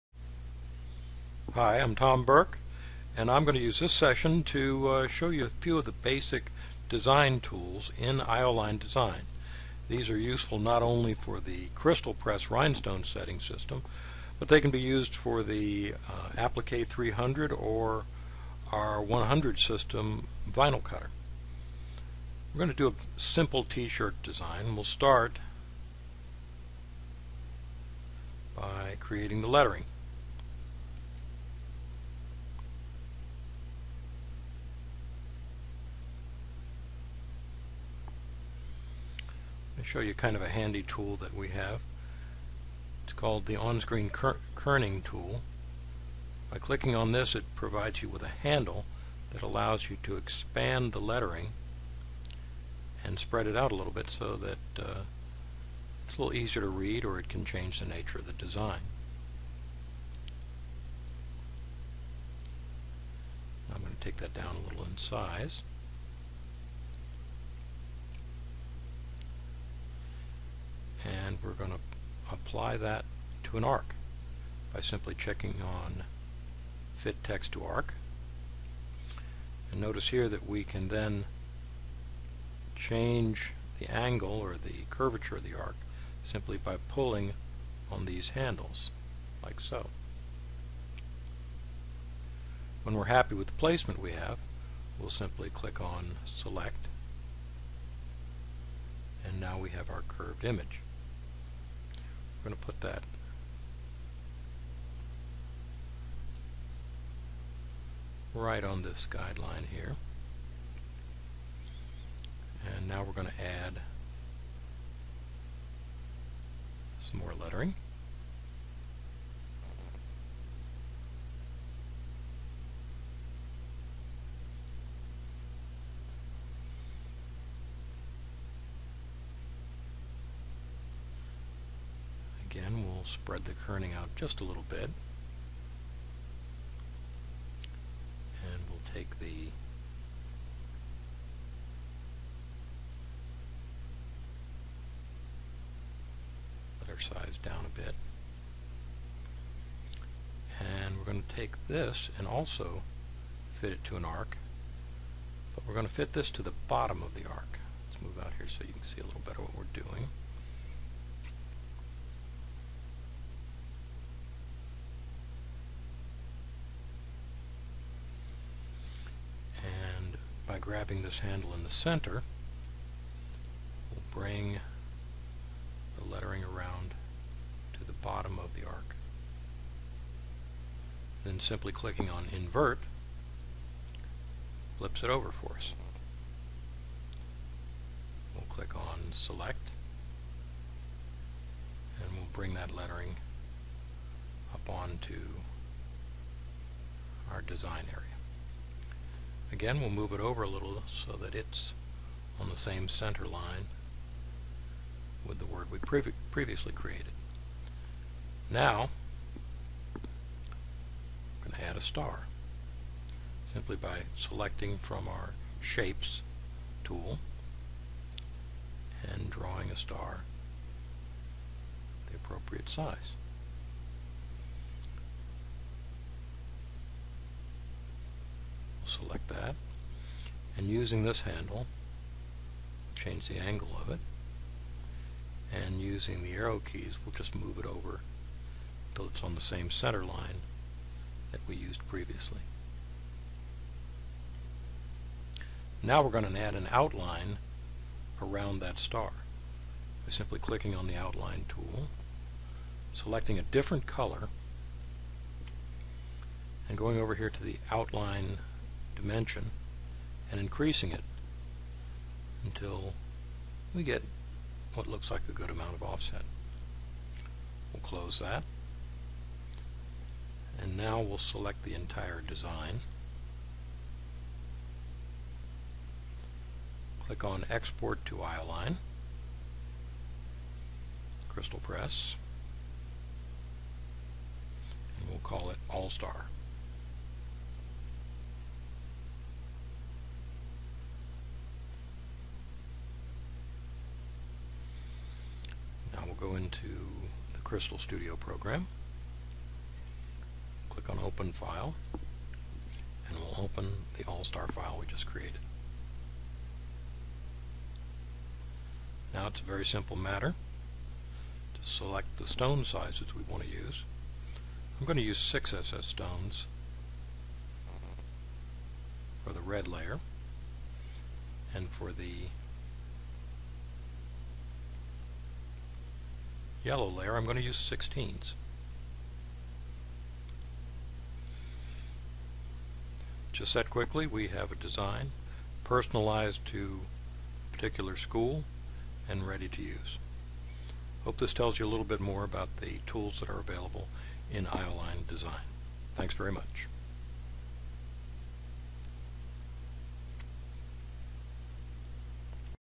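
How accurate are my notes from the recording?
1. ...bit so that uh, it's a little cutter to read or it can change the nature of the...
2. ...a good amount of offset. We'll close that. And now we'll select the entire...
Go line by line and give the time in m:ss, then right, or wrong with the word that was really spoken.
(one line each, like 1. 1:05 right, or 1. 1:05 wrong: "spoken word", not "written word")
1. 0:53 wrong: "easier", not "cutter"
2. 4:25 right.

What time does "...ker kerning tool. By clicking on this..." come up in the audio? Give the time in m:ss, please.
0:44.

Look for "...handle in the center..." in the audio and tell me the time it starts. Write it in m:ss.
2:51.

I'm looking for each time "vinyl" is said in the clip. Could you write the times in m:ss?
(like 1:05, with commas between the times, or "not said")
0:20.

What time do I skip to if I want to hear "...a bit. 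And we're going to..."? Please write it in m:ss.
2:27.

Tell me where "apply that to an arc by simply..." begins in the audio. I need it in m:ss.
1:12.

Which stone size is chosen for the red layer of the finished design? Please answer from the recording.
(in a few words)
6 SS.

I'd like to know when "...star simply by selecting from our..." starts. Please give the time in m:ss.
3:31.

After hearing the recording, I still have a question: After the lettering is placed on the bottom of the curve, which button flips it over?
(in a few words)
invert.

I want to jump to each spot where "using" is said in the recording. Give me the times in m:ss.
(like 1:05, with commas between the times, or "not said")
3:50, 3:55.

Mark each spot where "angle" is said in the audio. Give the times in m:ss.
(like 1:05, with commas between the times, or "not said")
1:23, 3:53.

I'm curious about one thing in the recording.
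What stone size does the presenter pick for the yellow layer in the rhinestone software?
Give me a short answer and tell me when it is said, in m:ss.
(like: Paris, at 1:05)
16, at 5:27.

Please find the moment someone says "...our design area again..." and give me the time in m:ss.
3:17.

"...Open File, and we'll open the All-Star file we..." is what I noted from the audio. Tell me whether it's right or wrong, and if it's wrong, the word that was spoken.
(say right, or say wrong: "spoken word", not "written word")
right.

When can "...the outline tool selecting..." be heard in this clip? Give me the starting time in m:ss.
4:10.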